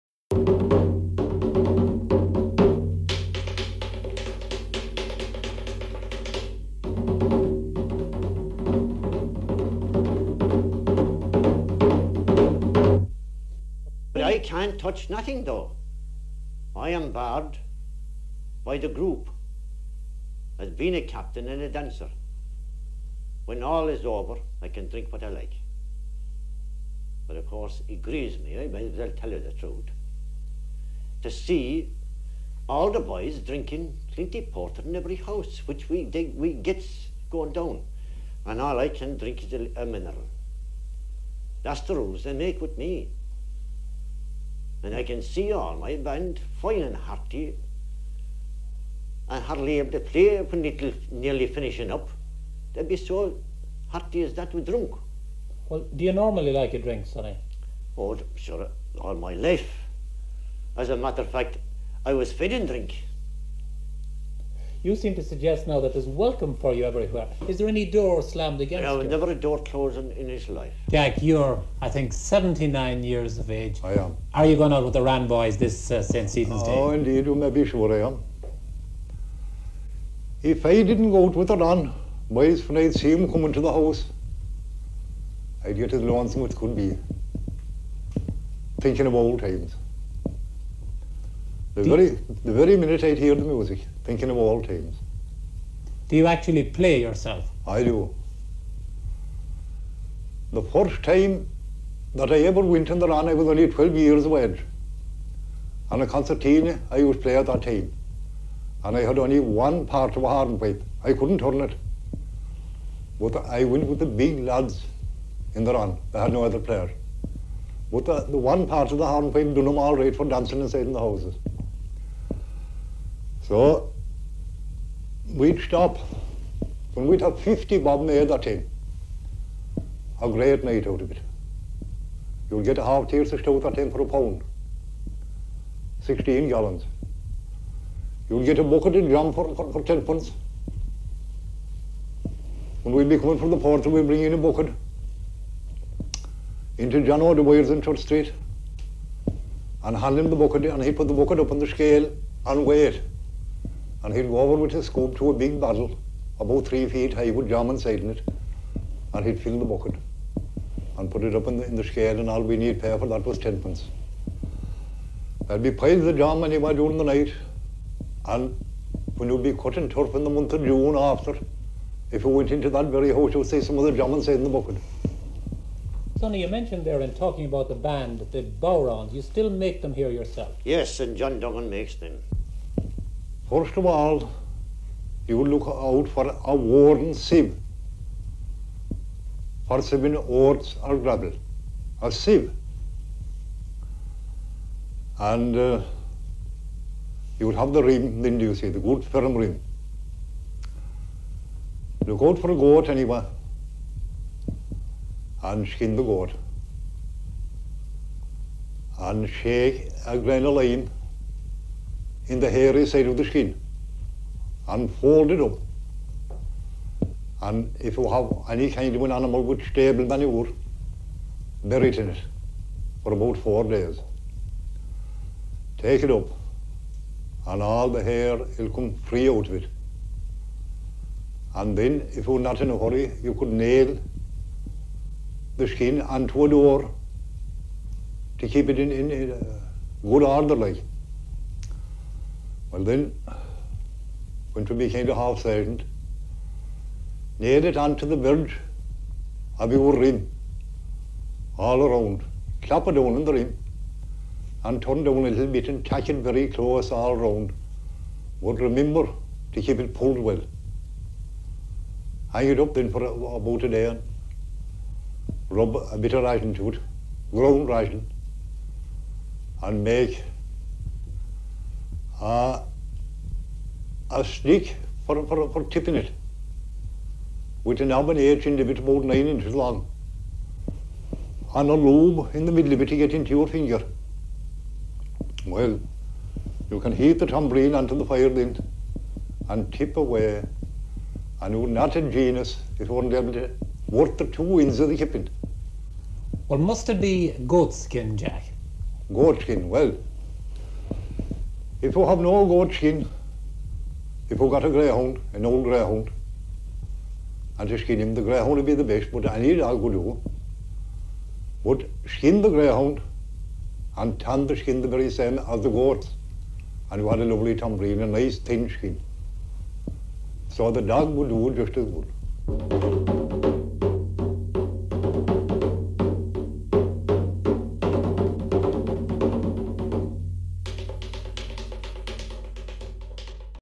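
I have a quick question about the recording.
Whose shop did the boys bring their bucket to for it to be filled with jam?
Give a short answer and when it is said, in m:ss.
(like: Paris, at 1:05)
John O'Dwyer's, at 2:27.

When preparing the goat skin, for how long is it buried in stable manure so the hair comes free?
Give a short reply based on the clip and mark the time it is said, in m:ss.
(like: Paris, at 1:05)
4 days, at 3:43.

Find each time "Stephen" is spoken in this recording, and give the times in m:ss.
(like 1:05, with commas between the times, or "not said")
1:16.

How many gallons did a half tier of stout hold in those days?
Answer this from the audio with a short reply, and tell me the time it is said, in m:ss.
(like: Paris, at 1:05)
16, at 2:16.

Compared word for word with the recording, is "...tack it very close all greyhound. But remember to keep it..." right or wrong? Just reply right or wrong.
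wrong.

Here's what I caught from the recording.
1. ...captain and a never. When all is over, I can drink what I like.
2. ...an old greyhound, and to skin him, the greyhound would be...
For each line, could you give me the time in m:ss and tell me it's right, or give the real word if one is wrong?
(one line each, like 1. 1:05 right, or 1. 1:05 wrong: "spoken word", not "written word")
1. 0:21 wrong: "dancer", not "never"
2. 5:05 right.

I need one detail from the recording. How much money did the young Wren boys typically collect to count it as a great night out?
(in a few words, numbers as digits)
50 bob.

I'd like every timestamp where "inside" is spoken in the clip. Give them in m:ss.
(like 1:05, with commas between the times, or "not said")
2:00, 2:37, 2:54.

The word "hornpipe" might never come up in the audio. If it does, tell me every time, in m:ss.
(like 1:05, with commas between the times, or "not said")
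1:50, 1:59.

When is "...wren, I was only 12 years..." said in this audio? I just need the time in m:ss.
1:43.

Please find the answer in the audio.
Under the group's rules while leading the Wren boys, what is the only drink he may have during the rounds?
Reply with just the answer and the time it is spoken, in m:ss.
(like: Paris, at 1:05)
A mineral, at 0:39.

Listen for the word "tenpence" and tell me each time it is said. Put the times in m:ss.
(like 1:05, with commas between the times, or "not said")
2:43.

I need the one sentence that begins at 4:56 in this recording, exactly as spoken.
Well, must it be goat skin, Jack?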